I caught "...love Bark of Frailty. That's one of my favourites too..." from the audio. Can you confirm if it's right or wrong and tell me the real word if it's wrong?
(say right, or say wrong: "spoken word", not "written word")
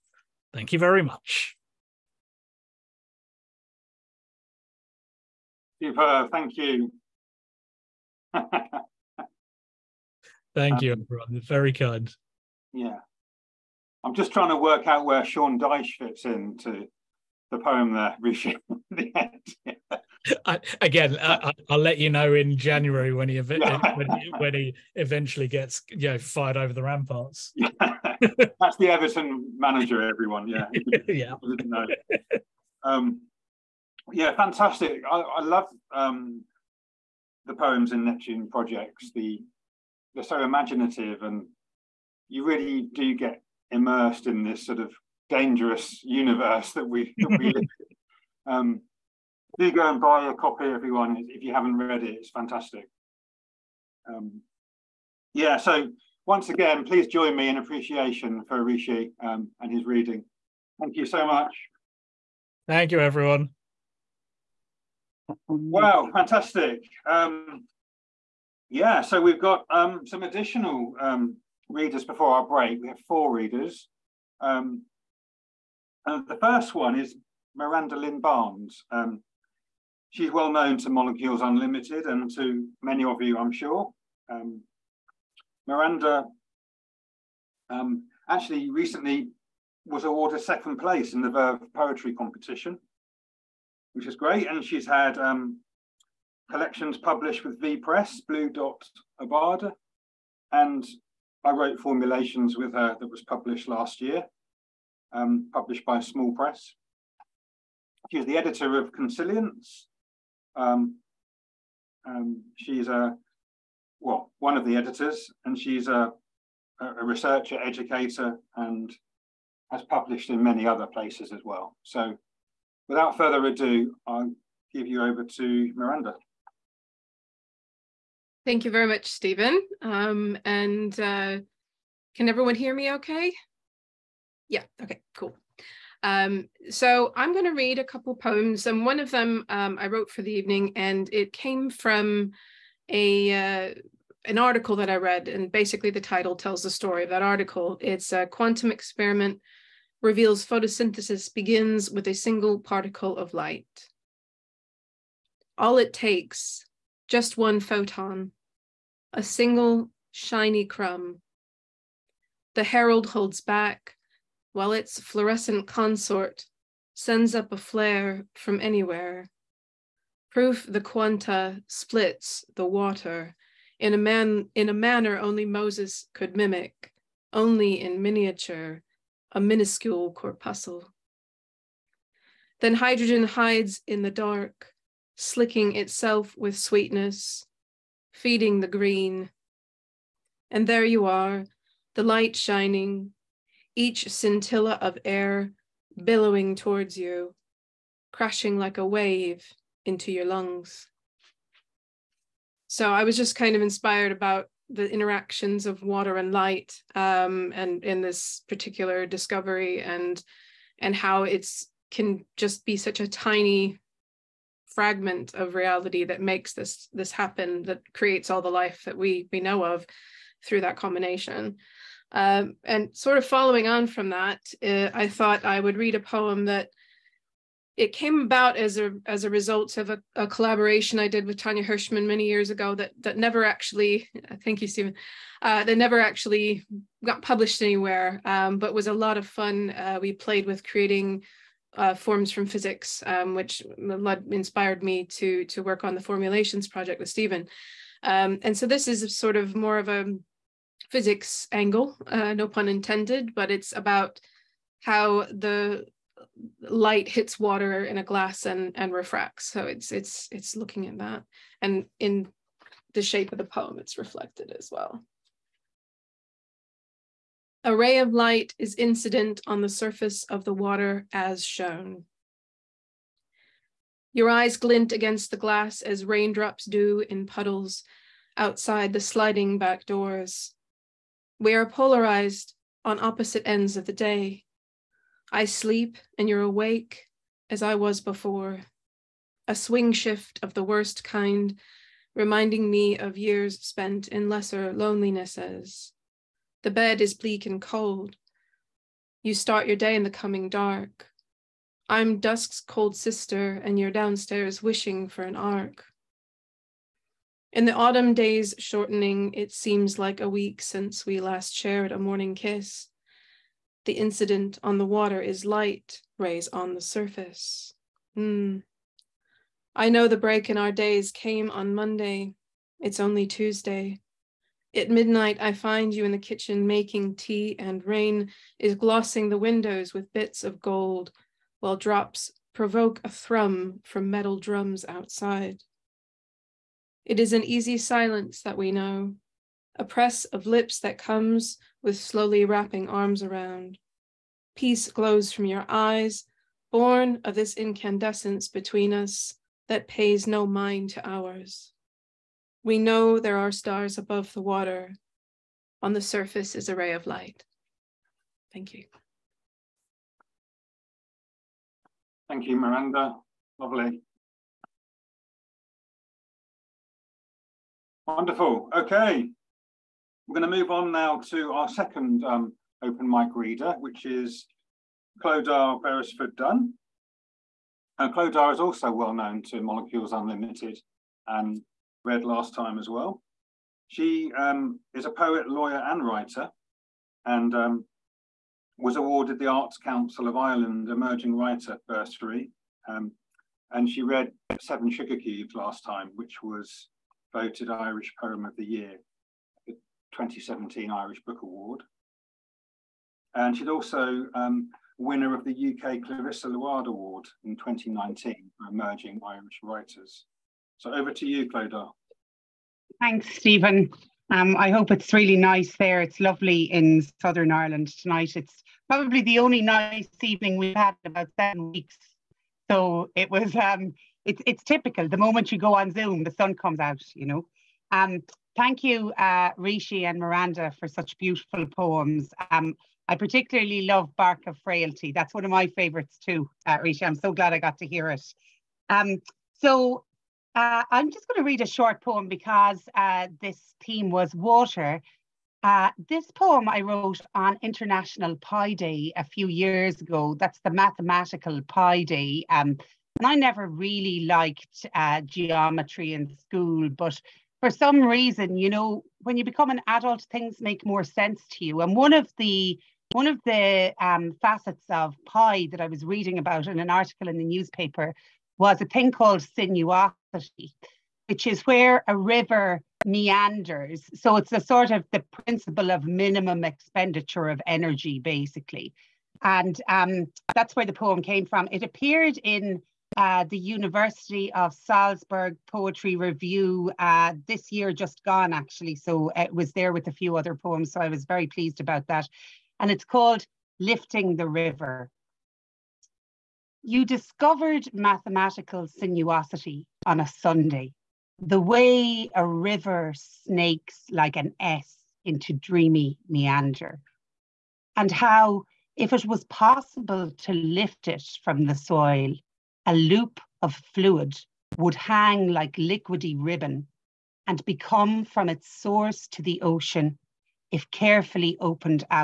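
right.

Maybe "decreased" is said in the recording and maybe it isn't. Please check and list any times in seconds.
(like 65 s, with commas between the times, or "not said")
not said.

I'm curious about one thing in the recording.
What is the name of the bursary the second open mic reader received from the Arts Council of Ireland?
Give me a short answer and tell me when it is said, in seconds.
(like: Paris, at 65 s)
Emerging Writer Bursary, at 390 s.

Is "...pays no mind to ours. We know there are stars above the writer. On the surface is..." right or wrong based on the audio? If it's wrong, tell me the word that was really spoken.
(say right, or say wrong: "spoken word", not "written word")
wrong: "water", not "writer".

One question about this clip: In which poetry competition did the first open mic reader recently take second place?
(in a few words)
Verve Poetry Competition.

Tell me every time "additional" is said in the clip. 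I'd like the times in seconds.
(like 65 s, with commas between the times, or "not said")
70 s.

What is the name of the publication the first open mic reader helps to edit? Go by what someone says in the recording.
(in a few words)
Consilience.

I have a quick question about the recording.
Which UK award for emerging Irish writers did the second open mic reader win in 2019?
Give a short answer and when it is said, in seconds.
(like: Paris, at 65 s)
Clarissa Luard Award, at 406 s.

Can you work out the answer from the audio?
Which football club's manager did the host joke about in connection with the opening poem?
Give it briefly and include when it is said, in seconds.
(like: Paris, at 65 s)
Everton, at 28 s.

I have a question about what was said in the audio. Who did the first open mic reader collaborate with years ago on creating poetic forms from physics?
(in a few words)
Tania Hershman.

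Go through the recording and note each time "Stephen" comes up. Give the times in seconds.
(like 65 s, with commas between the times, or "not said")
129 s, 234 s, 247 s, 413 s.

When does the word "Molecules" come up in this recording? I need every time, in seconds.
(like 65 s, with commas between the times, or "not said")
80 s, 379 s.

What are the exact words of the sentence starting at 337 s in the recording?
It is an easy silence that we know, a press of lips that comes with slowly wrapping arms around.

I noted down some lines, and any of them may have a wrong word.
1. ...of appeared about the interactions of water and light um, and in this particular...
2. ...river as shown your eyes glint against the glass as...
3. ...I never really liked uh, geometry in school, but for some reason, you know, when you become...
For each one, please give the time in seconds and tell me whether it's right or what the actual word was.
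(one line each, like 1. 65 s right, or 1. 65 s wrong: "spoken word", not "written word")
1. 203 s wrong: "inspired", not "appeared"
2. 270 s wrong: "water", not "river"
3. 453 s right.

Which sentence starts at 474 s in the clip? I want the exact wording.
So it's a sort of the principle of minimum expenditure of energy, basically.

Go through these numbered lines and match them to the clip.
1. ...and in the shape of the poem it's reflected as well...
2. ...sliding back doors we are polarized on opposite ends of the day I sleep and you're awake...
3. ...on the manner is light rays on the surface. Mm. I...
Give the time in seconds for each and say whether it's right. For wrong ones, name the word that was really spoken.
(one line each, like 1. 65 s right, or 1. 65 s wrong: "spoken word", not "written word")
1. 261 s right
2. 278 s right
3. 314 s wrong: "water", not "manner".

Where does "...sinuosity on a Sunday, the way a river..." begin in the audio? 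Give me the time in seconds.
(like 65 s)
498 s.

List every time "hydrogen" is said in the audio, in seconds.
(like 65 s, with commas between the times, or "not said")
182 s.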